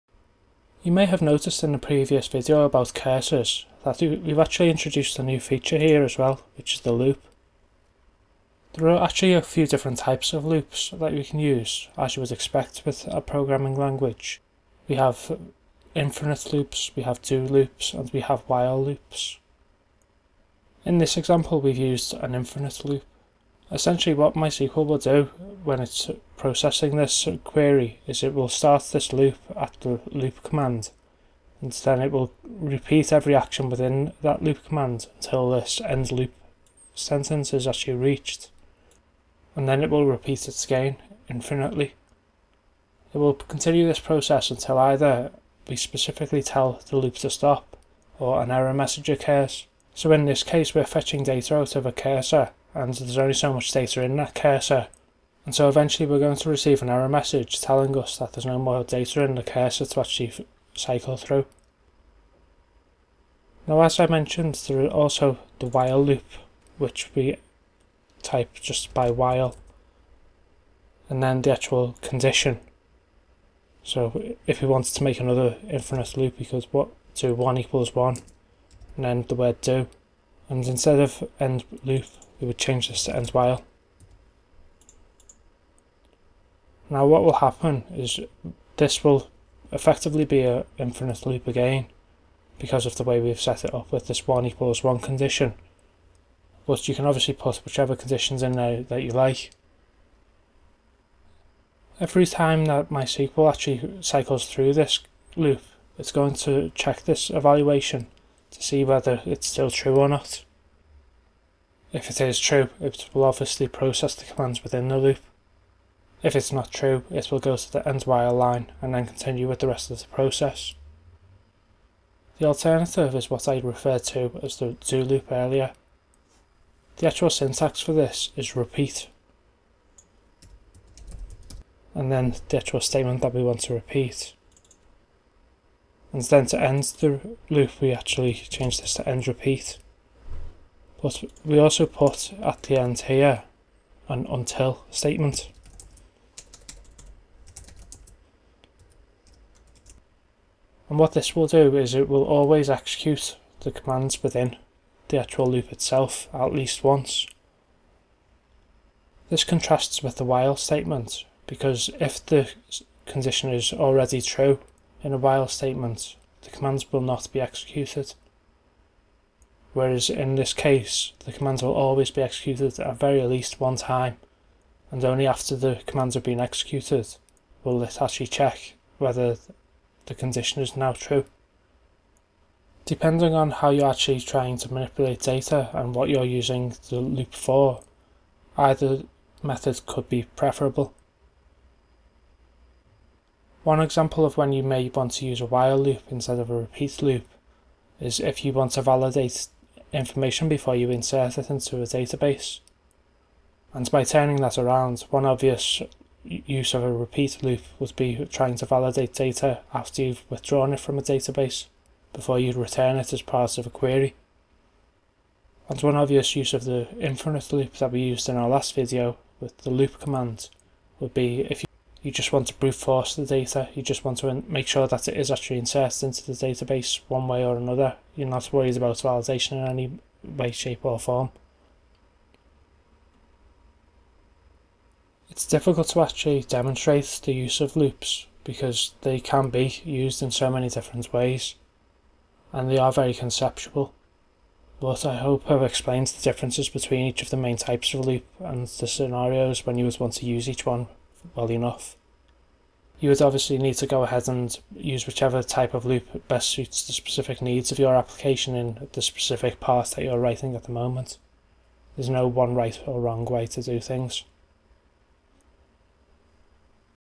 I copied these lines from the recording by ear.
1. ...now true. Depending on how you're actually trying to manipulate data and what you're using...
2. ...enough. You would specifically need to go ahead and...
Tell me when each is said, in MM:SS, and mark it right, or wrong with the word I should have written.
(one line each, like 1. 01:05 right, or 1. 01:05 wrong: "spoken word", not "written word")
1. 03:00 right
2. 04:11 wrong: "obviously", not "specifically".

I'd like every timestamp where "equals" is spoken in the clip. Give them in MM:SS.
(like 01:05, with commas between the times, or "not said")
01:17, 01:34.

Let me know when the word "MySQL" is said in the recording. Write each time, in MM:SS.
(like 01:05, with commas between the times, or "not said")
00:24, 01:42.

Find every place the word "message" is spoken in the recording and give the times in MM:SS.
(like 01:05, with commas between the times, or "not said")
00:48, 00:57.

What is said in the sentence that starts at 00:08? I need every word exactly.
There are actually a few different types of loops that we can use, as you would expect with a programming language.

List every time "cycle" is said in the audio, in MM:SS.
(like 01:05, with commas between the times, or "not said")
01:00, 01:44.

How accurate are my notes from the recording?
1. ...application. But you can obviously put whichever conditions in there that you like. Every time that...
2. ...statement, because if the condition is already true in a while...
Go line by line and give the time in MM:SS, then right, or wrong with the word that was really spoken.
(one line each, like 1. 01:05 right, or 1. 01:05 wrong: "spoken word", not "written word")
1. 01:34 wrong: "condition", not "application"
2. 02:40 right.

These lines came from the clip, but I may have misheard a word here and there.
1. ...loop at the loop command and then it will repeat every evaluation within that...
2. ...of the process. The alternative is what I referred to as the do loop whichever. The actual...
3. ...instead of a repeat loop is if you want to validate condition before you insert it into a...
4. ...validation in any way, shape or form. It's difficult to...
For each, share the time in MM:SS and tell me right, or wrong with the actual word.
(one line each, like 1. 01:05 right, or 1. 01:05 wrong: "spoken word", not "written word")
1. 00:29 wrong: "action", not "evaluation"
2. 01:59 wrong: "earlier", not "whichever"
3. 03:16 wrong: "information", not "condition"
4. 03:48 right.